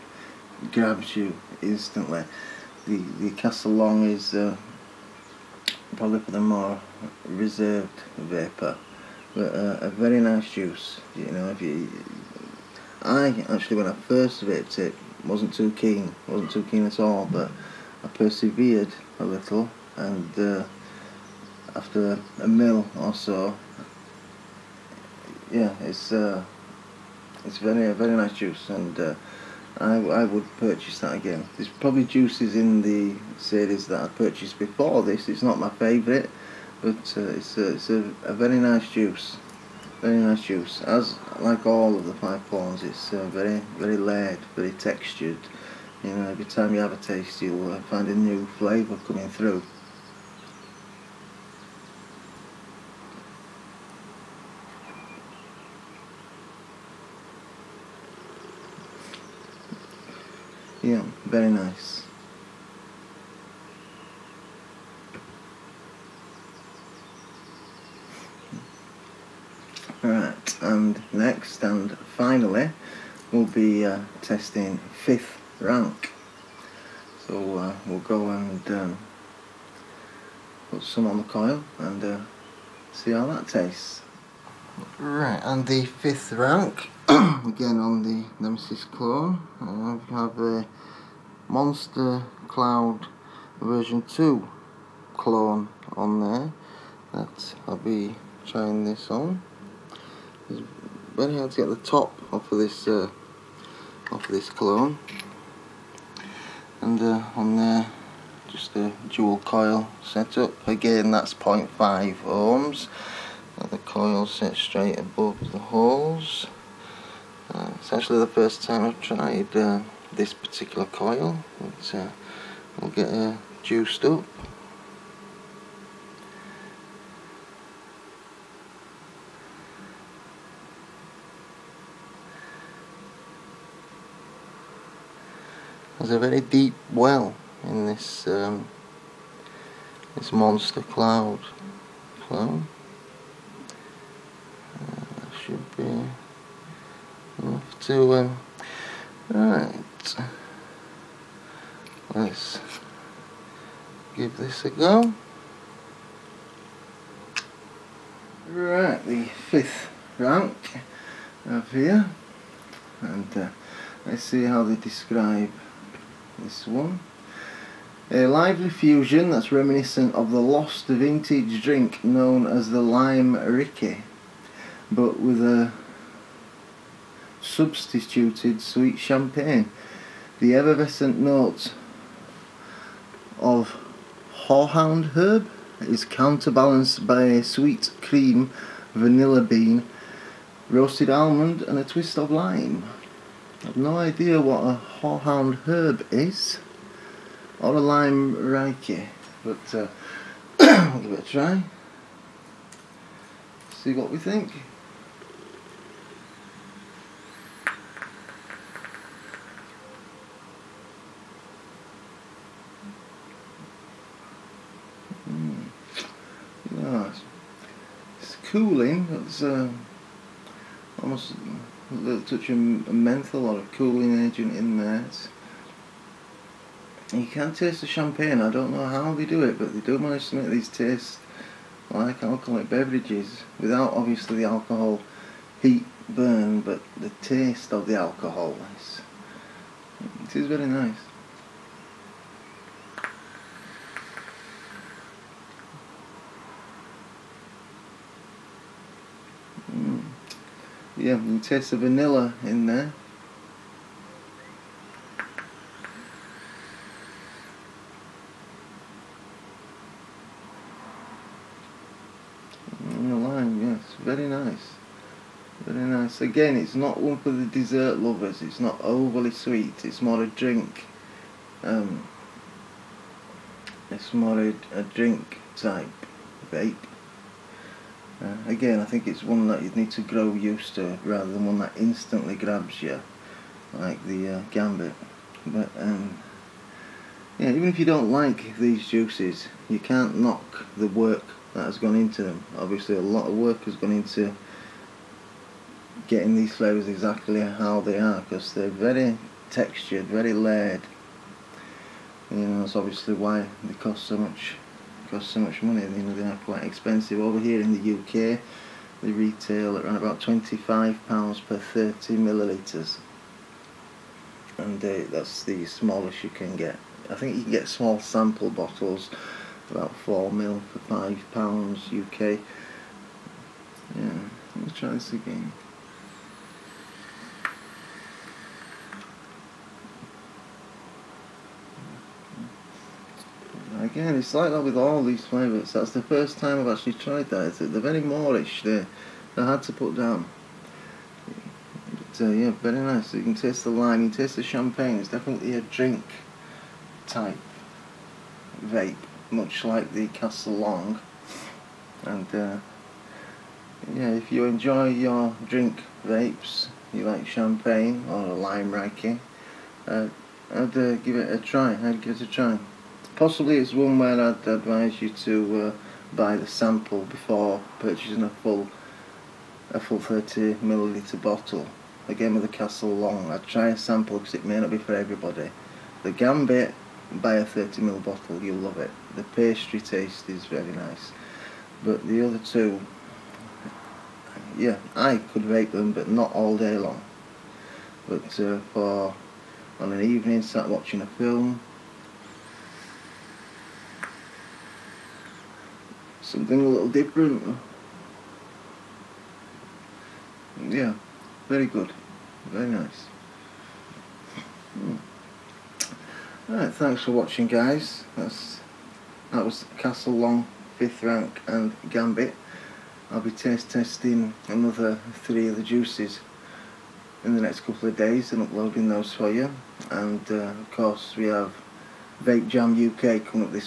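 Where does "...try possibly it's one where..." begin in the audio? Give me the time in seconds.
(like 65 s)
362 s.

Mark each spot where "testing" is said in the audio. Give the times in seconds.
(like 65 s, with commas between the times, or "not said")
74 s, 413 s.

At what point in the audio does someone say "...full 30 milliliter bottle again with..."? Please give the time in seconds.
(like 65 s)
369 s.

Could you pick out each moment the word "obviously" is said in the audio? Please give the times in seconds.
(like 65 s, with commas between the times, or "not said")
233 s, 292 s, 302 s.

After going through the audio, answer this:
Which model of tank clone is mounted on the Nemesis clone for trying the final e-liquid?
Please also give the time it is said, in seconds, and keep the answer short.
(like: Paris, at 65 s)
Monster Cloud version 2, at 91 s.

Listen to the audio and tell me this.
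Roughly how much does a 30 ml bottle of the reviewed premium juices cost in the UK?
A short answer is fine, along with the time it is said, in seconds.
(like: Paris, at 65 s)
£25, at 310 s.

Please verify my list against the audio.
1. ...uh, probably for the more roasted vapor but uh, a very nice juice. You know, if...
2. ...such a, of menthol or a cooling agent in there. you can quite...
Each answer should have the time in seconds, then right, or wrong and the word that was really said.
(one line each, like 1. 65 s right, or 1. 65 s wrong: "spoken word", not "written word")
1. 4 s wrong: "reserved", not "roasted"
2. 222 s wrong: "taste", not "quite".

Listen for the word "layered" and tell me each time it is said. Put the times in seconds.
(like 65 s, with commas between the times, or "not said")
43 s, 300 s.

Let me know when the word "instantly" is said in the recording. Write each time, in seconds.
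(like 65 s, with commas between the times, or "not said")
1 s, 281 s.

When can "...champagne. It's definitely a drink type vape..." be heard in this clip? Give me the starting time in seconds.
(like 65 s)
344 s.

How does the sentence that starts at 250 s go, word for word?
Yeah, you taste the vanilla in there.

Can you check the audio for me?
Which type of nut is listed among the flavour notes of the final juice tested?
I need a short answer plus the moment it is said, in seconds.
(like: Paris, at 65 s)
Roasted almond, at 190 s.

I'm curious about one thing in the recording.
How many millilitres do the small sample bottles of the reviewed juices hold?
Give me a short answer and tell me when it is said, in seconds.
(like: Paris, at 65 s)
4 ml, at 319 s.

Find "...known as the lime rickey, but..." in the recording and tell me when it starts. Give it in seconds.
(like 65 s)
172 s.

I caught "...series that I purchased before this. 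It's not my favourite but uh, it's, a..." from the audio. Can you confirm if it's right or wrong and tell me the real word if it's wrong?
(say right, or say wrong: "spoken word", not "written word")
right.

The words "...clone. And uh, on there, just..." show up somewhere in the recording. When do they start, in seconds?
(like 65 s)
104 s.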